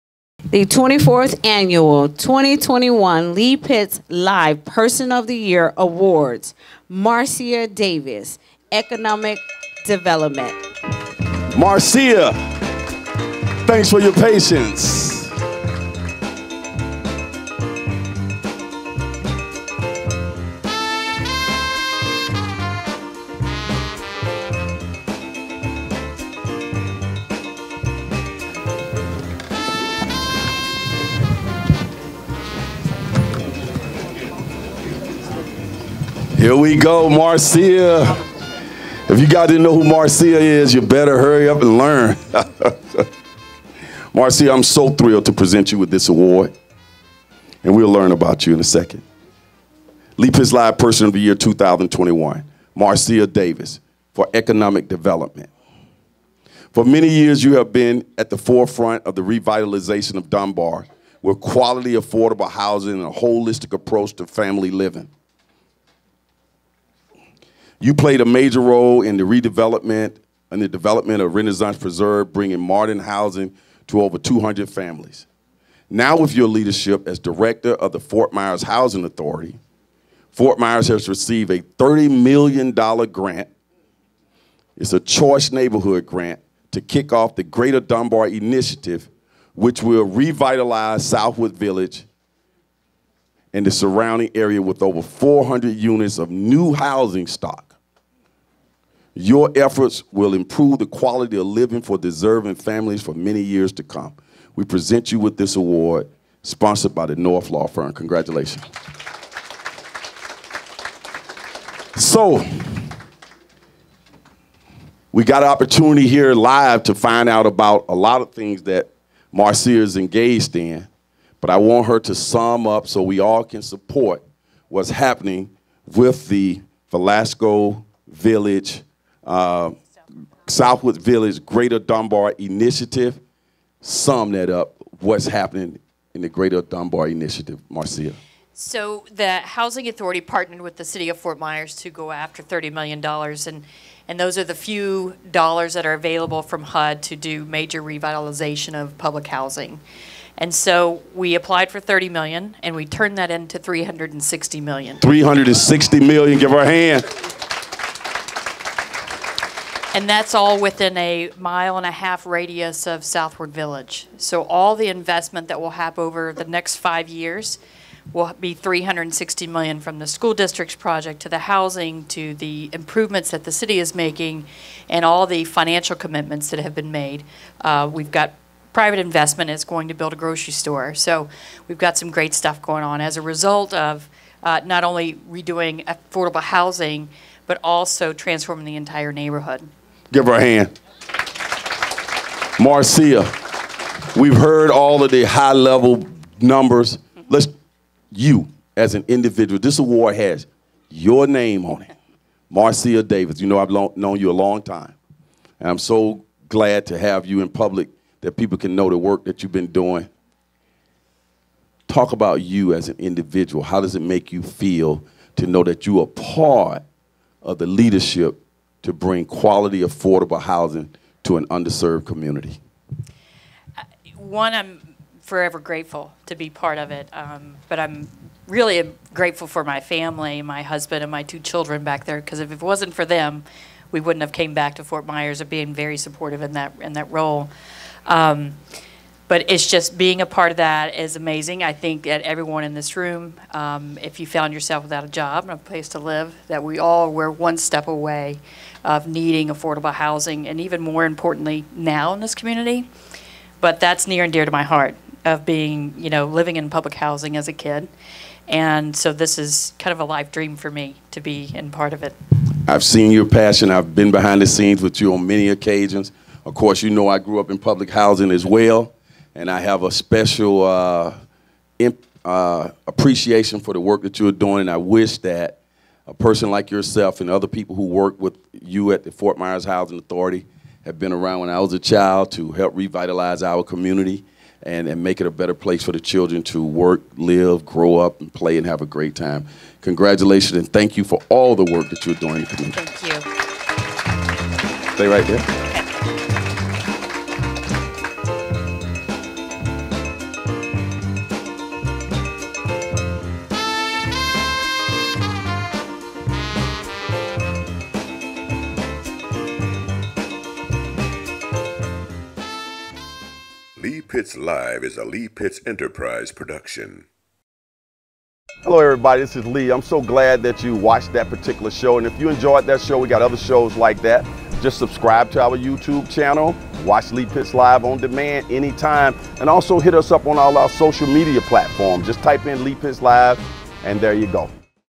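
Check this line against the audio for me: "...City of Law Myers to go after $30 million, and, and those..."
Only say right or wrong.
wrong.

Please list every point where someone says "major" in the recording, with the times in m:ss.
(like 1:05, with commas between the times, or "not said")
1:08, 2:27.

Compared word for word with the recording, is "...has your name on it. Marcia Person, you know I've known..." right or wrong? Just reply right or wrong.
wrong.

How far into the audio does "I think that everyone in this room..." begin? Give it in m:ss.
4:01.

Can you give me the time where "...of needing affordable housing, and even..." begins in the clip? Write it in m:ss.
4:08.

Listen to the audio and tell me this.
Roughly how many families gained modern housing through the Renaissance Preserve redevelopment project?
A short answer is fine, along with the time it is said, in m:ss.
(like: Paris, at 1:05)
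over 200, at 1:14.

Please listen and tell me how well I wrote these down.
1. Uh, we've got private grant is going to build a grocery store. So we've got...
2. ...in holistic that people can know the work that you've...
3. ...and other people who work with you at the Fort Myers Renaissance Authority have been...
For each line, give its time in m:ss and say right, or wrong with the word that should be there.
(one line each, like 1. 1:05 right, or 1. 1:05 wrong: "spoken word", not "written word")
1. 2:57 wrong: "investment", not "grant"
2. 3:27 wrong: "public", not "holistic"
3. 4:37 wrong: "Housing", not "Renaissance".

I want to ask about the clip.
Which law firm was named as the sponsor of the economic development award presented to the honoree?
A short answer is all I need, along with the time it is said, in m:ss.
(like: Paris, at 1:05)
North Law Firm, at 1:47.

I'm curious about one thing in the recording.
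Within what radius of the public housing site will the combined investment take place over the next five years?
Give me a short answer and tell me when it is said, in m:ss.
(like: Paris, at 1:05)
a mile and a half, at 2:40.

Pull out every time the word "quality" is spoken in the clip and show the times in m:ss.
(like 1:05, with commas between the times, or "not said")
1:01, 1:40, 3:39.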